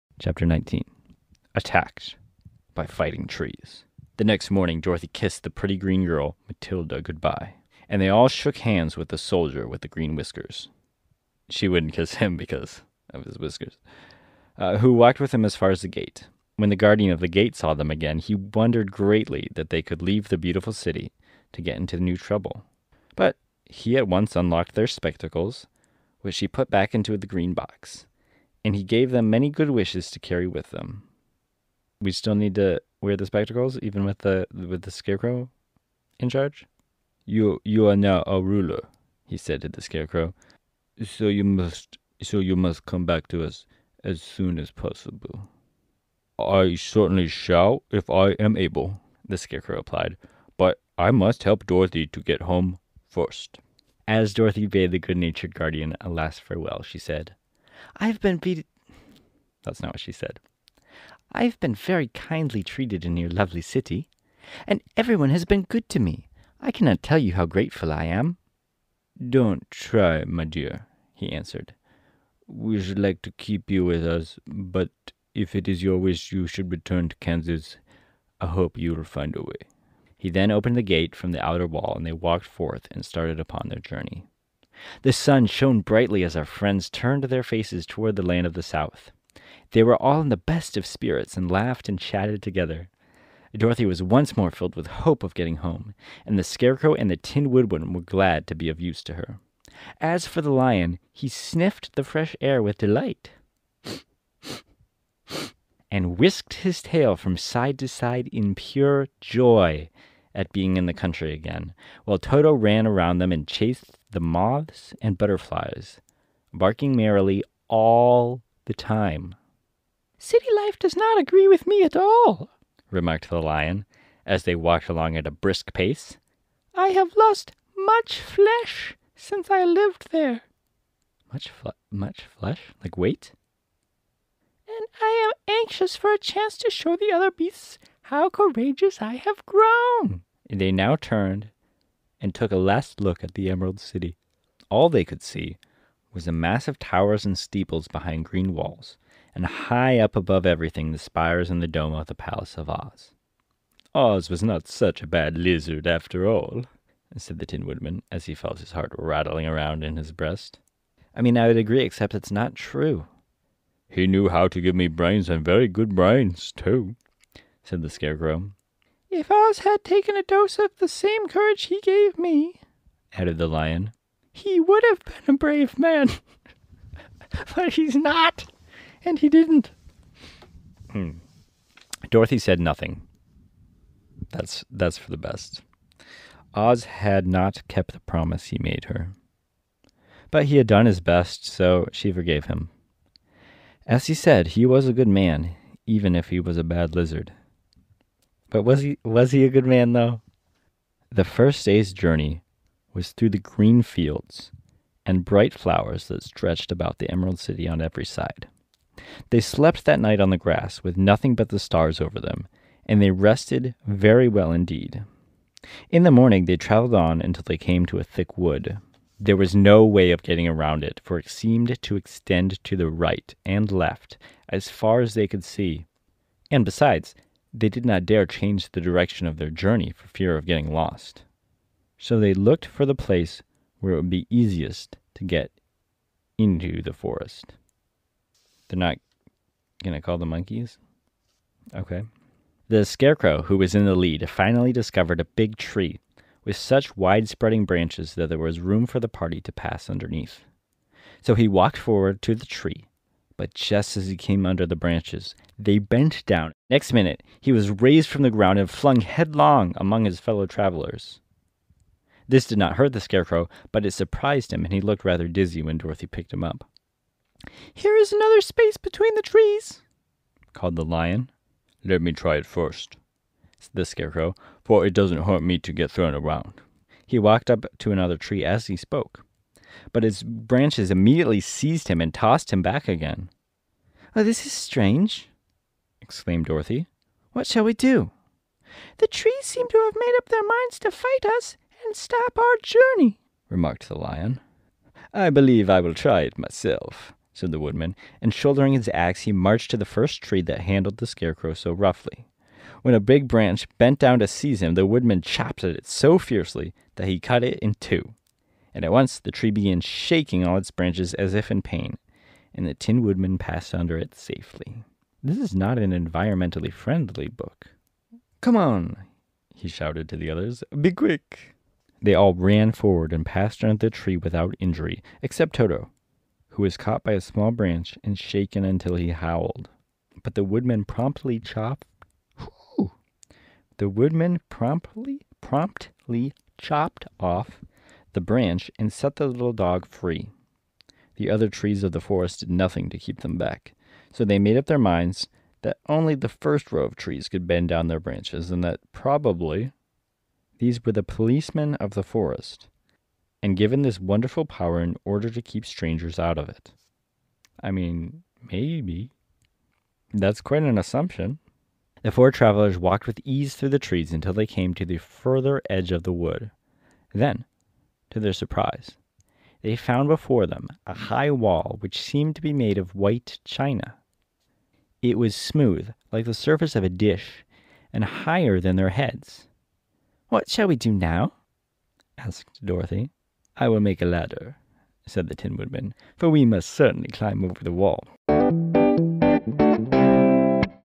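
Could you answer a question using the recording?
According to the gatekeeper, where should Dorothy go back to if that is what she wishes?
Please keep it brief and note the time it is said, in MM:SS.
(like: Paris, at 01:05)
Kansas, at 01:17.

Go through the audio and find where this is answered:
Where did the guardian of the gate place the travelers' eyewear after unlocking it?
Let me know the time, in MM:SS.
00:27.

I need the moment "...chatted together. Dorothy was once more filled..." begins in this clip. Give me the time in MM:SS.
01:31.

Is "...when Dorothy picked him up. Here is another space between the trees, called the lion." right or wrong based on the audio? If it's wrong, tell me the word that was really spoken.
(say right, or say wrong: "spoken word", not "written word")
right.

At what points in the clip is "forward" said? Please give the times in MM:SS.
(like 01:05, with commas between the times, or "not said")
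04:11, 05:22.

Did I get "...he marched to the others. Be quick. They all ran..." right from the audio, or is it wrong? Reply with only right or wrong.
wrong.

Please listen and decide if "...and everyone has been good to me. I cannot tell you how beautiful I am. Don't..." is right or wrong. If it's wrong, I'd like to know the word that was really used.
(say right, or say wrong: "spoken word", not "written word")
wrong: "grateful", not "beautiful".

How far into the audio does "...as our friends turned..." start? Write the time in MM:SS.
01:26.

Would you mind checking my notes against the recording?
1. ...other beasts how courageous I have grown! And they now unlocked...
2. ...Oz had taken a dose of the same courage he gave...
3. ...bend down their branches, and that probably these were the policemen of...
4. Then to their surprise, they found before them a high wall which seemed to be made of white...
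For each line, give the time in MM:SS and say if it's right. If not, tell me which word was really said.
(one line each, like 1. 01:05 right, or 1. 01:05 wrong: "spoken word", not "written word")
1. 02:17 wrong: "turned", not "unlocked"
2. 02:49 right
3. 05:47 right
4. 06:07 right.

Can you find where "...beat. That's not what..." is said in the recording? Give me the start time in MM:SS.
00:58.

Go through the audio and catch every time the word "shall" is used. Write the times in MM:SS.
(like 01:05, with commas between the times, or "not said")
00:47, 04:47, 06:20.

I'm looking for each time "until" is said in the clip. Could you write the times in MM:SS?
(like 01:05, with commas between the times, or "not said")
03:37, 05:28, 06:04.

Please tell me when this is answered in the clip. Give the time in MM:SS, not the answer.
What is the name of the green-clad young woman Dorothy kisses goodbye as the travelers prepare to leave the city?
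00:06.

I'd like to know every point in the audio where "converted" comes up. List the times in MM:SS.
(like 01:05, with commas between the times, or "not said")
not said.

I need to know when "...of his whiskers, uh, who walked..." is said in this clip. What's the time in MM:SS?
00:13.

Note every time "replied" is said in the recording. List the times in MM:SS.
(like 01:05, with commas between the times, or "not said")
00:49.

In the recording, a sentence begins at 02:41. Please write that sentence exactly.
I mean, I would agree, except it's not true.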